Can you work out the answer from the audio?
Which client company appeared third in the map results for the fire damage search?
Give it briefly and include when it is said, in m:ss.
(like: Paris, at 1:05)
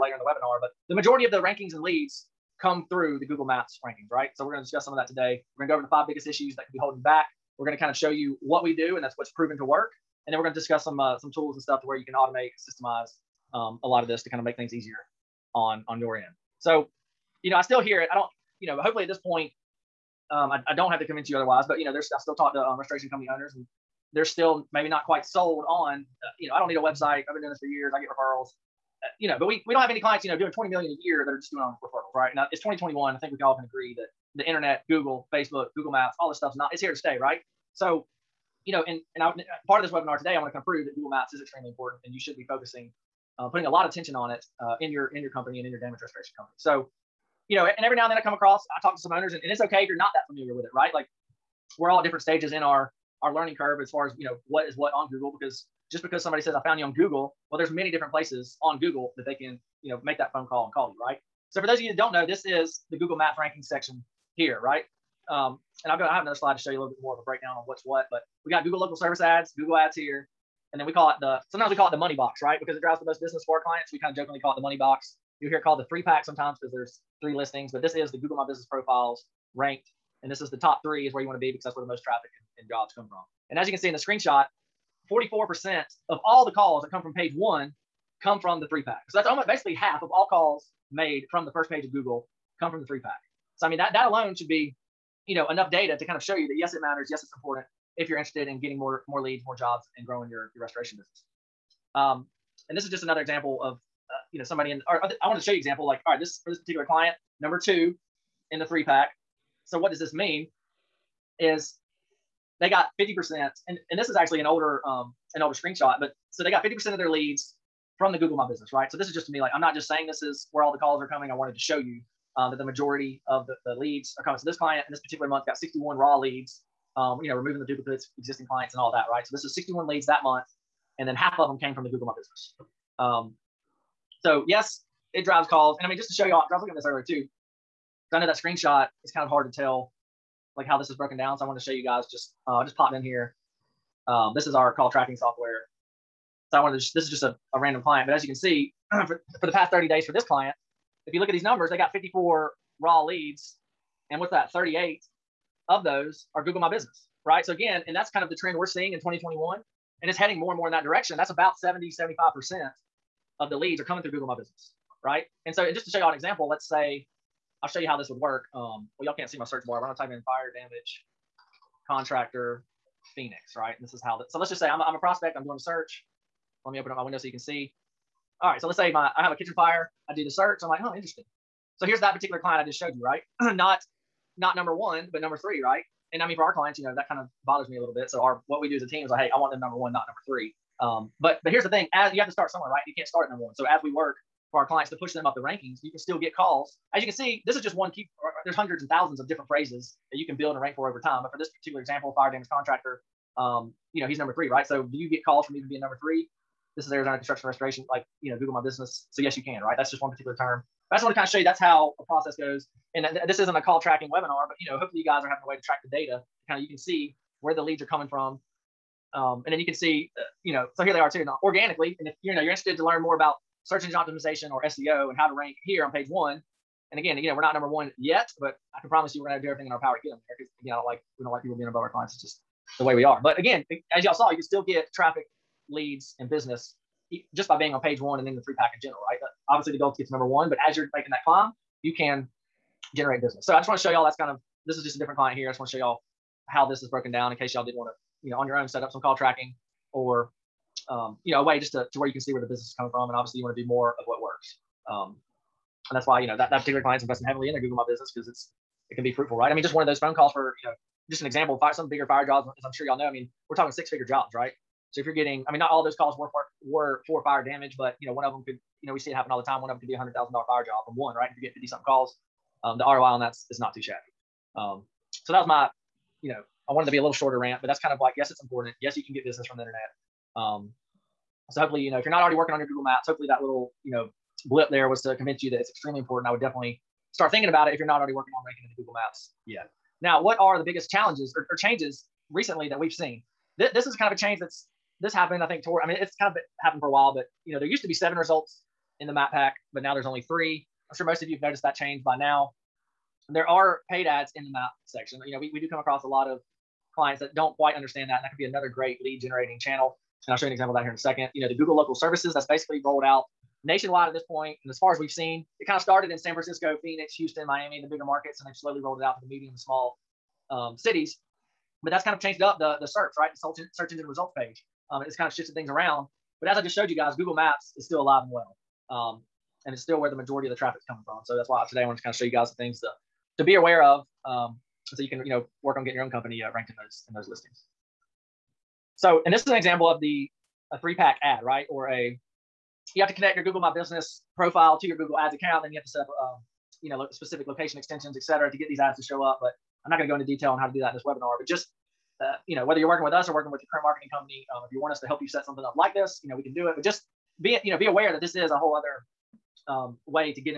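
Arizona Construction Restoration, at 3:26.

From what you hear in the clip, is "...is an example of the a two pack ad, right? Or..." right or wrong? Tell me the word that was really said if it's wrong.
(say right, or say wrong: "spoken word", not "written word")
wrong: "three", not "two".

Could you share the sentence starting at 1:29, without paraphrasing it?
So that's almost basically half of all calls made from the first page of Google come from the three pack.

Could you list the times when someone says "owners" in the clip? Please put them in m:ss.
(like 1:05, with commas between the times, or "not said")
0:23, 0:49.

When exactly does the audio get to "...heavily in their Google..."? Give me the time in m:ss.
4:17.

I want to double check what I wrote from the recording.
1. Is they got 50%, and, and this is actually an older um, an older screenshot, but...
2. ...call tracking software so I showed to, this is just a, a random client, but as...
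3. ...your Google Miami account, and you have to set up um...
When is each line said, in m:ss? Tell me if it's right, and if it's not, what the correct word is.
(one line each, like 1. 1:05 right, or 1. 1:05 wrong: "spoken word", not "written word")
1. 1:51 right
2. 2:24 wrong: "wanted", not "showed"
3. 5:44 wrong: "Ads", not "Miami".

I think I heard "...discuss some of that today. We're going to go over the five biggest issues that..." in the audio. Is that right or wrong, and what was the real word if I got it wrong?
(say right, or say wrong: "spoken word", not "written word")
right.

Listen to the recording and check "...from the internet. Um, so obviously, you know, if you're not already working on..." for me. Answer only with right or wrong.
wrong.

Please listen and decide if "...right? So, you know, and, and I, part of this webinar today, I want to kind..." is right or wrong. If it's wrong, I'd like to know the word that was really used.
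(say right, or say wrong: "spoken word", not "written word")
right.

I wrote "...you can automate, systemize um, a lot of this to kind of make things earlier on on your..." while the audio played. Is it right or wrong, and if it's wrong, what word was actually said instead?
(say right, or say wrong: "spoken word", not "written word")
wrong: "easier", not "earlier".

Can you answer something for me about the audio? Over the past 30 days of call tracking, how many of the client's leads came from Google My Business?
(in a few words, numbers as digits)
38.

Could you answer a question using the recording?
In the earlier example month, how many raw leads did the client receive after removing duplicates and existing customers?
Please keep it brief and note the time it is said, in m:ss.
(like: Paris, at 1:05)
61, at 2:05.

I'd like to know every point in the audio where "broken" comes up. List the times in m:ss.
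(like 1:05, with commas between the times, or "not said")
2:20, 4:06.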